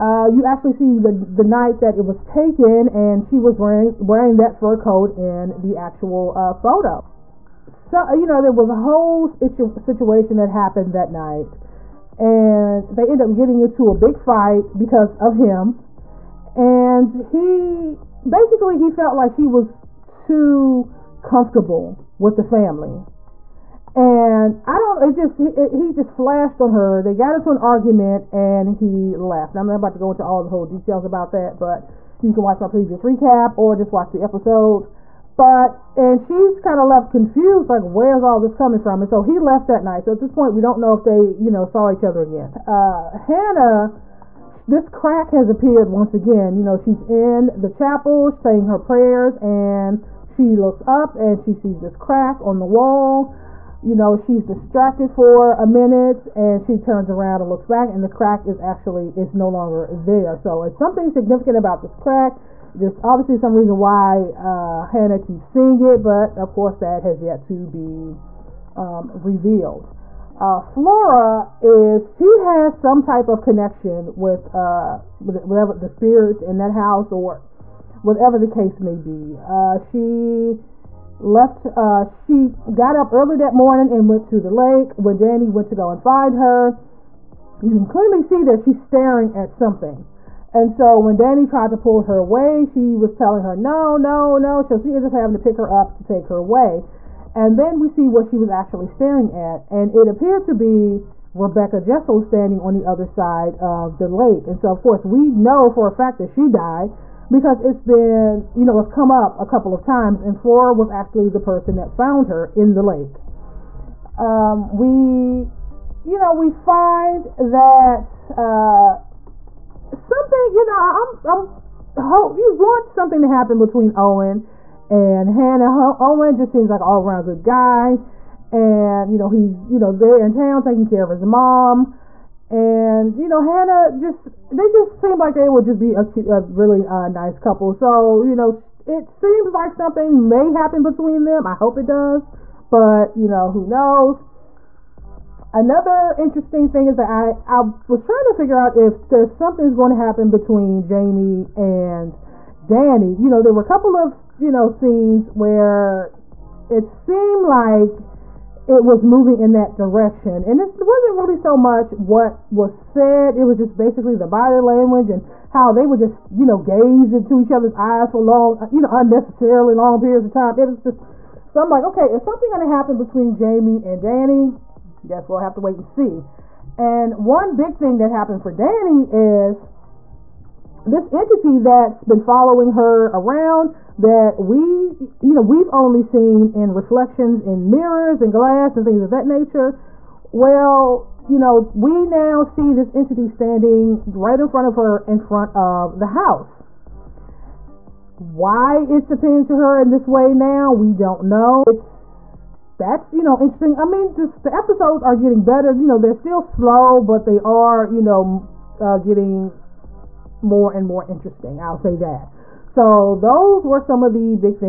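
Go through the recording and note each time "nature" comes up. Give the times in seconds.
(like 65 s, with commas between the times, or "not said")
189 s.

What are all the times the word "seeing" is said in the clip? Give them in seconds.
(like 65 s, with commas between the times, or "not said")
65 s.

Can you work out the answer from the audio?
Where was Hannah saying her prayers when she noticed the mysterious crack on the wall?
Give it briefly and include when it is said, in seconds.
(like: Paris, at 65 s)
the chapel, at 47 s.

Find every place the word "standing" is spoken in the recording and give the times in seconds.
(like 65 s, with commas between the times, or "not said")
102 s, 193 s.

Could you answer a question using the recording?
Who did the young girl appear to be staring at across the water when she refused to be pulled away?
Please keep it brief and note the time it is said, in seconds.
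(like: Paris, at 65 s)
Rebecca Jessel, at 101 s.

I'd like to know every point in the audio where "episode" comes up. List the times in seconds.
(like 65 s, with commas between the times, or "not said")
34 s, 204 s.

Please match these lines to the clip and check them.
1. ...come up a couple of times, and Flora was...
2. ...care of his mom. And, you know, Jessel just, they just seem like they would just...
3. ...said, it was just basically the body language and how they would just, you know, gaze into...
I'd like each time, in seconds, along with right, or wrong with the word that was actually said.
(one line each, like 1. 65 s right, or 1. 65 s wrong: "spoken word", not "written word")
1. 108 s right
2. 130 s wrong: "Hannah", not "Jessel"
3. 162 s right.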